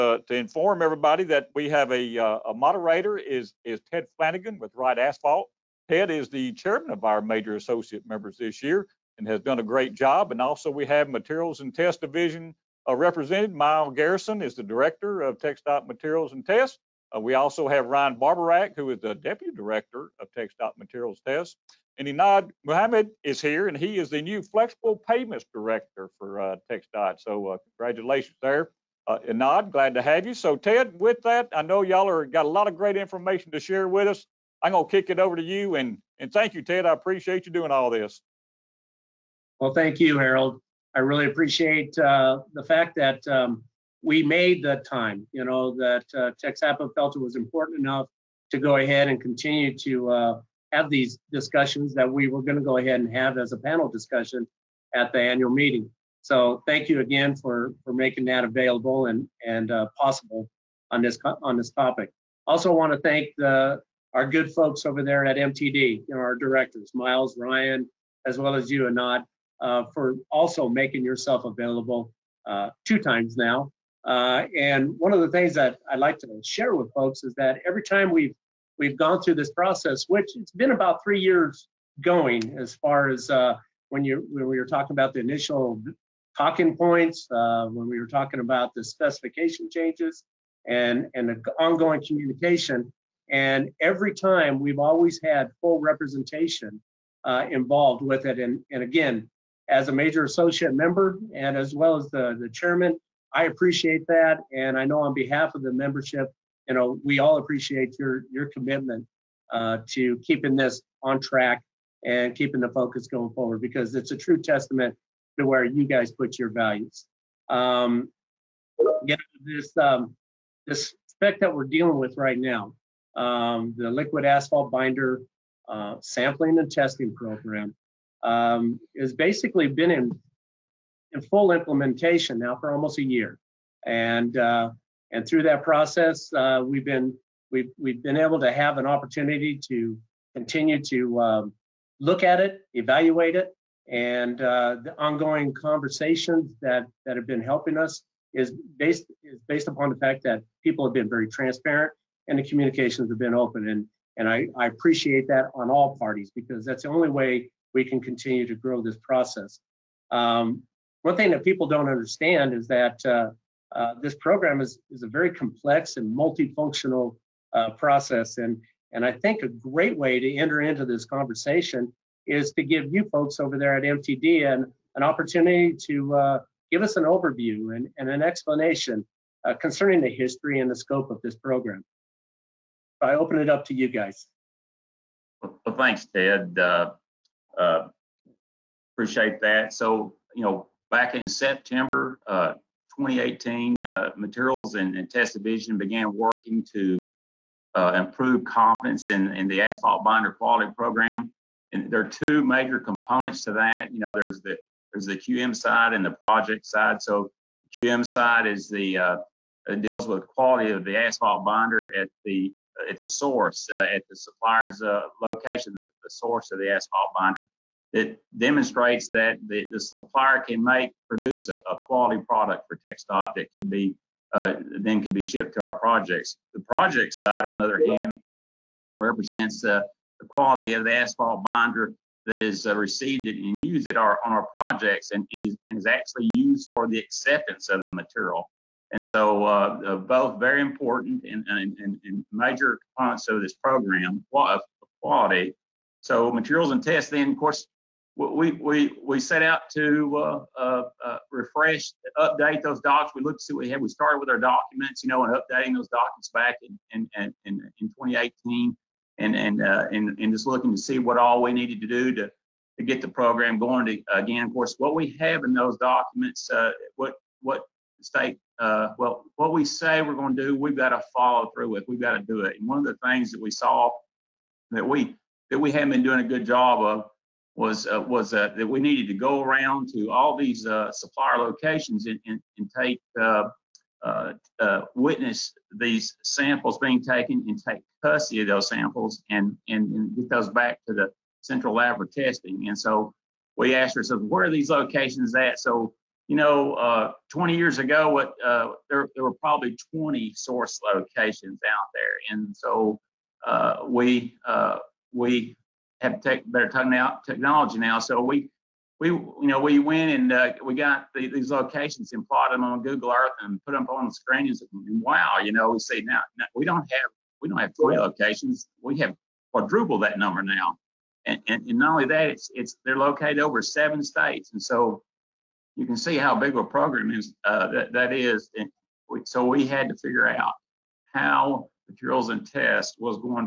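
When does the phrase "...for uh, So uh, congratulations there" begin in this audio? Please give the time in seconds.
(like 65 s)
26 s.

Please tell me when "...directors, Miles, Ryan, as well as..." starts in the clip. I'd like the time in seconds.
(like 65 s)
66 s.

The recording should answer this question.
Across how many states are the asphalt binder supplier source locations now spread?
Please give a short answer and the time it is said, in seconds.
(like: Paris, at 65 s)
7, at 323 s.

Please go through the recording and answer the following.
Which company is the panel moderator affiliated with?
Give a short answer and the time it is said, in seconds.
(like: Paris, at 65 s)
Wright Asphalt, at 4 s.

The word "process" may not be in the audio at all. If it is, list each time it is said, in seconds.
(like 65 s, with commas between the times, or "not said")
79 s, 135 s, 158 s, 167 s.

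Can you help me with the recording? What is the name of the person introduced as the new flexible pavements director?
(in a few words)
Enad Mahmoud.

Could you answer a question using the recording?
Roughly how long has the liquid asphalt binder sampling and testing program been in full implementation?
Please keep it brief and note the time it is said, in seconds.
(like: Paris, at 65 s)
almost a year, at 132 s.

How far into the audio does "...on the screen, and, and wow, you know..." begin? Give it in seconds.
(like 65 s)
313 s.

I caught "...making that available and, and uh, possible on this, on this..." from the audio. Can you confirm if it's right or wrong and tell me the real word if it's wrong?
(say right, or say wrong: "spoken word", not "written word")
right.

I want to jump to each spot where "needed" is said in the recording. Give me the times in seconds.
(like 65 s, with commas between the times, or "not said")
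261 s, 278 s.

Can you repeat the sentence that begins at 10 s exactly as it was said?
And also we have Materials and Test Division uh, represented.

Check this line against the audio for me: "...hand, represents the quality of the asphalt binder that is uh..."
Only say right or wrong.
right.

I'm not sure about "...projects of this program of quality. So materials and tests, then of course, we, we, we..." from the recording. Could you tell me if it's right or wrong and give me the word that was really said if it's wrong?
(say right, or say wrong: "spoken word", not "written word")
wrong: "components", not "projects".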